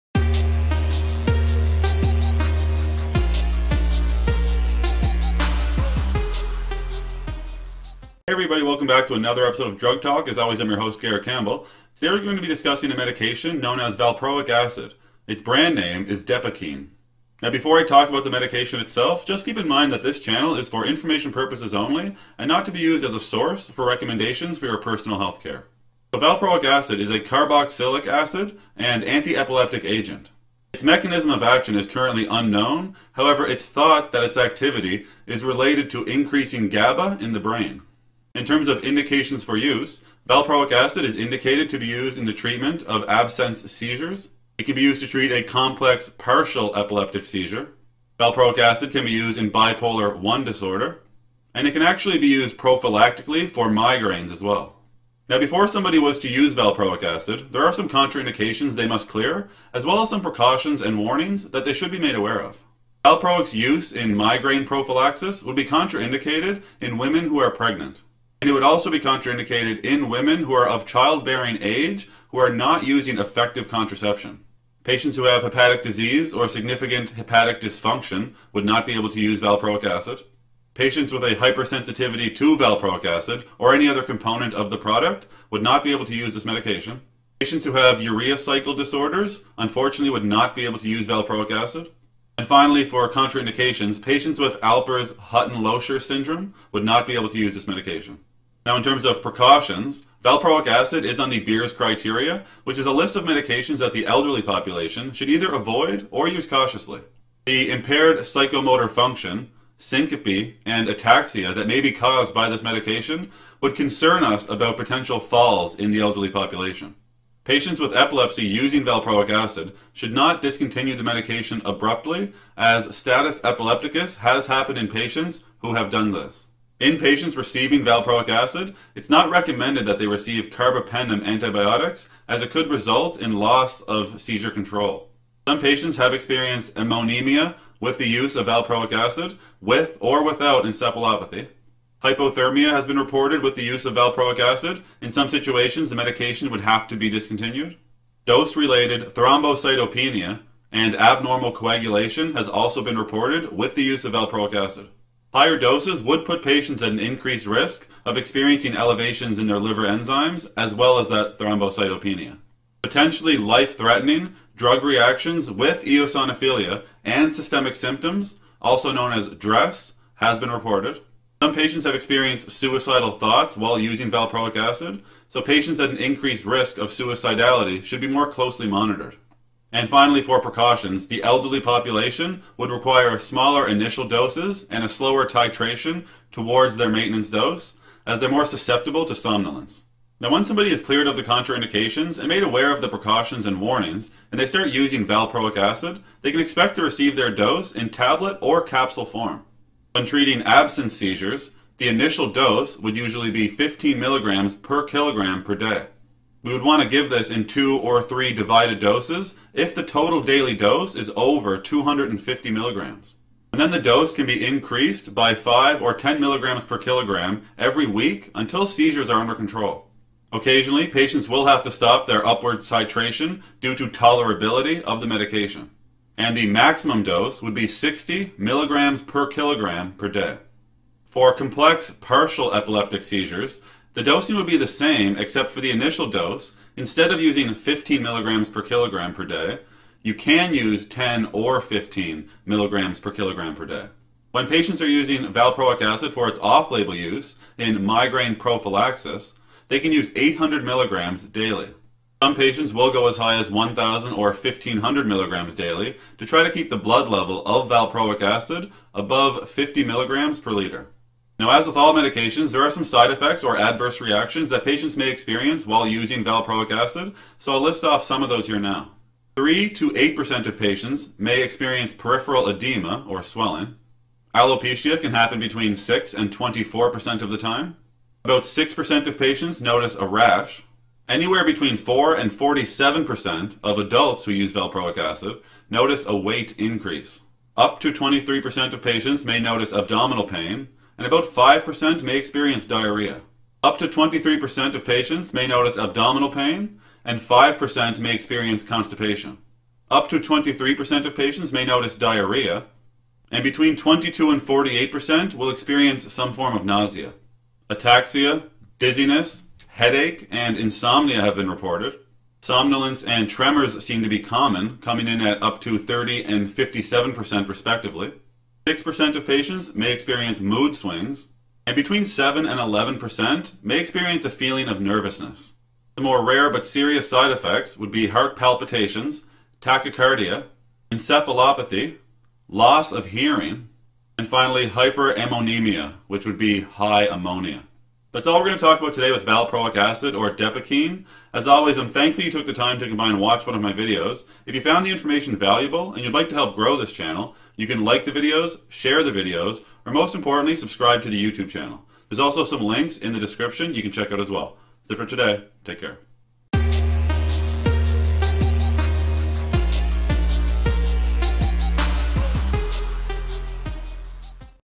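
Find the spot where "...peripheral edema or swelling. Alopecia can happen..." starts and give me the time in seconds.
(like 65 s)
271 s.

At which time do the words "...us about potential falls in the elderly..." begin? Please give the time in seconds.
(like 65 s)
114 s.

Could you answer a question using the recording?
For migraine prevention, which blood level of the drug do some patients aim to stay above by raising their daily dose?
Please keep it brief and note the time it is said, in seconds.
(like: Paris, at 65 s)
50 mg/L, at 259 s.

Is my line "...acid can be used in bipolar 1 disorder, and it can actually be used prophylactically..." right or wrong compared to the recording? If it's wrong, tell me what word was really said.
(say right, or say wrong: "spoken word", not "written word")
right.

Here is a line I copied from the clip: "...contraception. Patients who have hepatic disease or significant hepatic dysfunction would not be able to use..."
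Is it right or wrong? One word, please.
right.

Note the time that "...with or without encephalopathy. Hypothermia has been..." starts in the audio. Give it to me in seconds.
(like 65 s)
139 s.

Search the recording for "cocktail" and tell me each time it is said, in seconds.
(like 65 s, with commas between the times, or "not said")
not said.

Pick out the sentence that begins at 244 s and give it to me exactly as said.
When patients are using valproic acid for its off label use in migraine prophylaxis, they can use 800 milligrams daily.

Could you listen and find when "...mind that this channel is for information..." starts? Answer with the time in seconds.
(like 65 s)
19 s.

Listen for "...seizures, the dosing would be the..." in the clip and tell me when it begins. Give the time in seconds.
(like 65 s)
233 s.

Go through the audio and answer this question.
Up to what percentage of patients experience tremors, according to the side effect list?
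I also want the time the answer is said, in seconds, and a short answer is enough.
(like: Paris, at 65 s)
57%, at 316 s.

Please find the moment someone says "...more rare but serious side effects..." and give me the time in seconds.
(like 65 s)
326 s.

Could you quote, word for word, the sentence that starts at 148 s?
Dose-related thrombocytopenia and abnormal coagulation has also been reported with the use of valproic acid.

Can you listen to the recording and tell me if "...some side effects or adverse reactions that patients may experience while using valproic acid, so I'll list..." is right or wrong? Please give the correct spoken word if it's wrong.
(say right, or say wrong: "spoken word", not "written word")
right.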